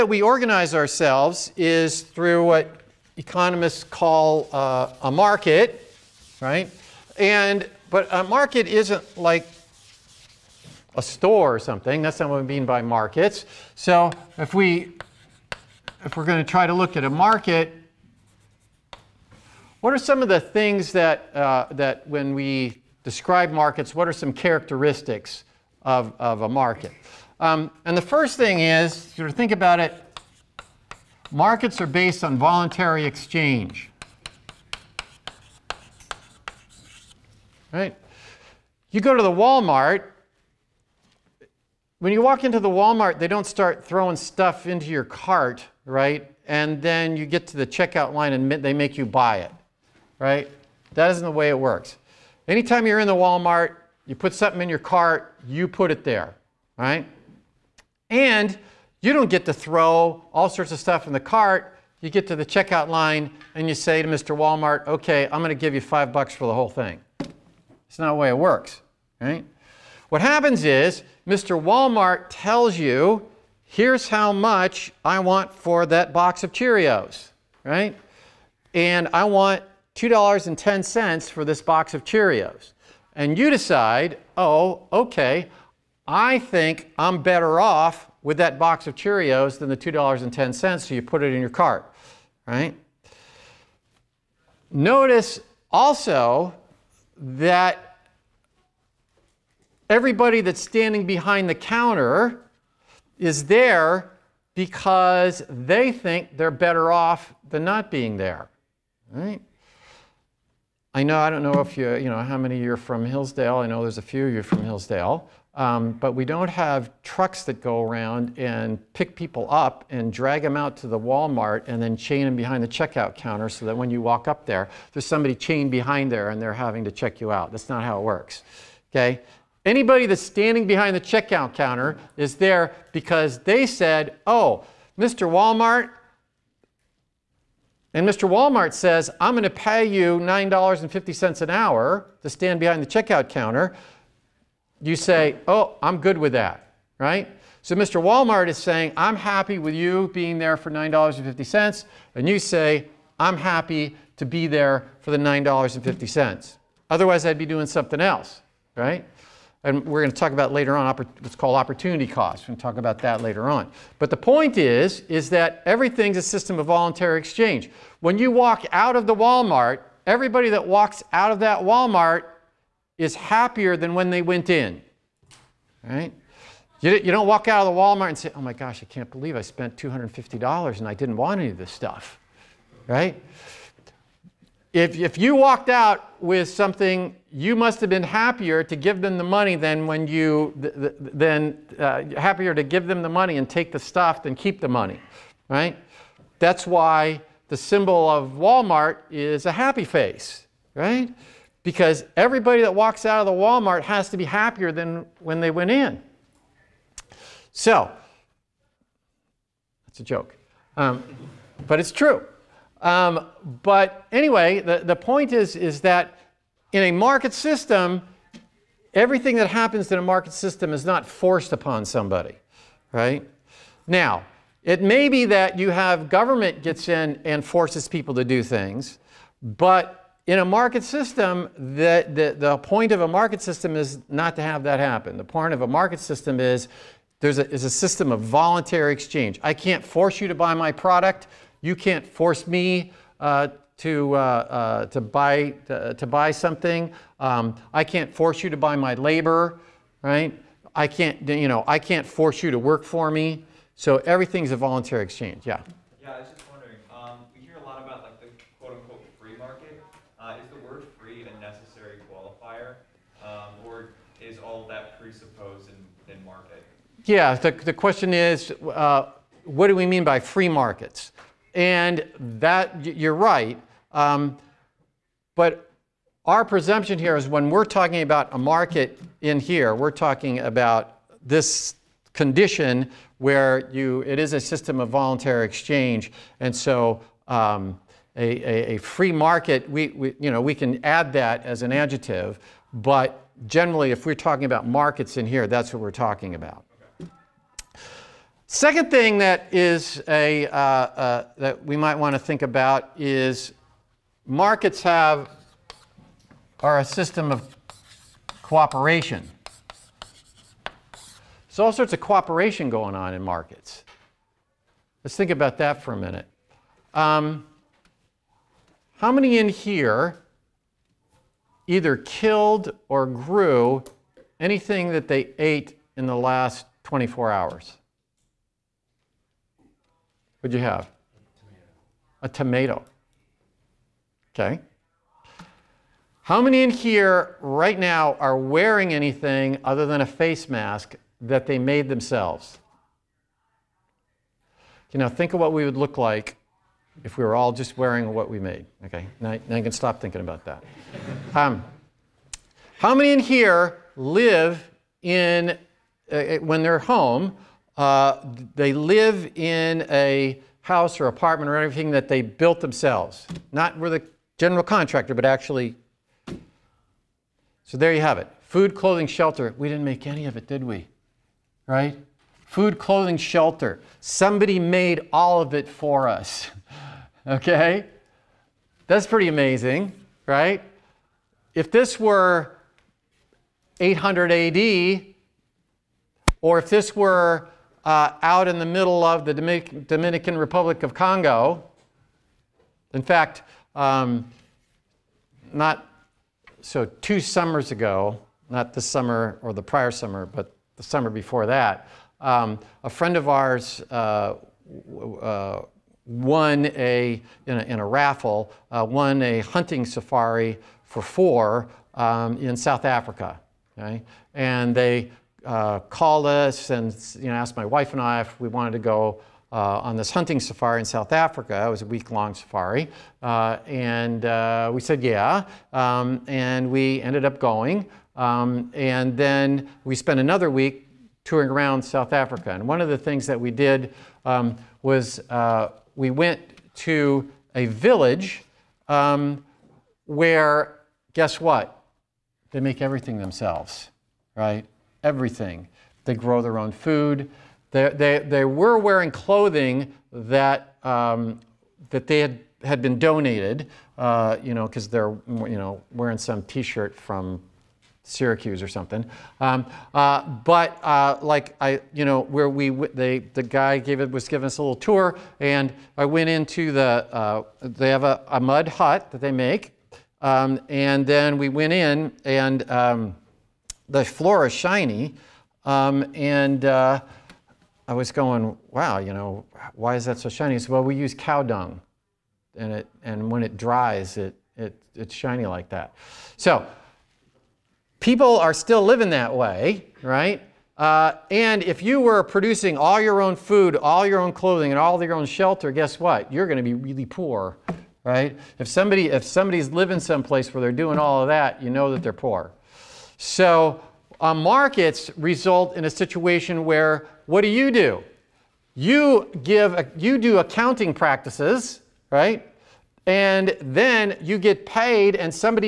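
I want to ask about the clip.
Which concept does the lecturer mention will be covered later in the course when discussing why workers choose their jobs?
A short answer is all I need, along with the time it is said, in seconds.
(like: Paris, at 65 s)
opportunity cost, at 161 s.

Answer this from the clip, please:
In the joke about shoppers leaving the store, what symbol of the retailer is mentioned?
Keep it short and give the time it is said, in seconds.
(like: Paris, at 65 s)
a happy face, at 199 s.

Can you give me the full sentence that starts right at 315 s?
Let's think about that for a minute.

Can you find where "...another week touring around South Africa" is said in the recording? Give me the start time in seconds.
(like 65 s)
430 s.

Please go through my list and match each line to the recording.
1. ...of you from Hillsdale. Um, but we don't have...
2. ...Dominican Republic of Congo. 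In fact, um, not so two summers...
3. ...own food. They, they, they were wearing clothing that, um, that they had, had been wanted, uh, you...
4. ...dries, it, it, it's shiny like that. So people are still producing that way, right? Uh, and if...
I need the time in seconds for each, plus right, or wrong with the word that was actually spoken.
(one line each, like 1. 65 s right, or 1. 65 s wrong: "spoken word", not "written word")
1. 114 s right
2. 389 s right
3. 446 s wrong: "donated", not "wanted"
4. 483 s wrong: "living", not "producing".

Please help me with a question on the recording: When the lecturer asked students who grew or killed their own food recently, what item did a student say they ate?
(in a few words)
a tomato.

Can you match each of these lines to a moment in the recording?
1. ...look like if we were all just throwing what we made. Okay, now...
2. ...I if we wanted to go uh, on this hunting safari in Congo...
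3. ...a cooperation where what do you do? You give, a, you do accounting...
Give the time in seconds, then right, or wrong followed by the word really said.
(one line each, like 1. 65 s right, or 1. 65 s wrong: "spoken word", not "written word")
1. 345 s wrong: "wearing", not "throwing"
2. 418 s wrong: "South", not "Congo"
3. 505 s wrong: "situation", not "cooperation".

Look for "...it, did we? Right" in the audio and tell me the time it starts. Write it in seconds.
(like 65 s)
370 s.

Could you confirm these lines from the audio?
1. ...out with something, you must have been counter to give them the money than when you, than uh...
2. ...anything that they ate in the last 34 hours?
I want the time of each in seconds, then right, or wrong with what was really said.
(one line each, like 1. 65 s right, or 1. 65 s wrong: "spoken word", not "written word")
1. 185 s wrong: "happier", not "counter"
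2. 324 s wrong: "24", not "34".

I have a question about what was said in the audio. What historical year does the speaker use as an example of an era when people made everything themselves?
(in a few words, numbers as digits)
800 AD.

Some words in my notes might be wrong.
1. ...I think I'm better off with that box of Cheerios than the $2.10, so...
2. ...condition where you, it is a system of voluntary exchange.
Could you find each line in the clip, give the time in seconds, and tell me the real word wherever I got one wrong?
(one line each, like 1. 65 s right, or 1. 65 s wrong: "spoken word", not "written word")
1. 86 s right
2. 282 s right.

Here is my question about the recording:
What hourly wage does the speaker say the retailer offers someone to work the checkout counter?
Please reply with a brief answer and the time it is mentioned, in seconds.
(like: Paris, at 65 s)
$9.50, at 140 s.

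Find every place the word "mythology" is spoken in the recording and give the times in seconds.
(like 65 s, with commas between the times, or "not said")
not said.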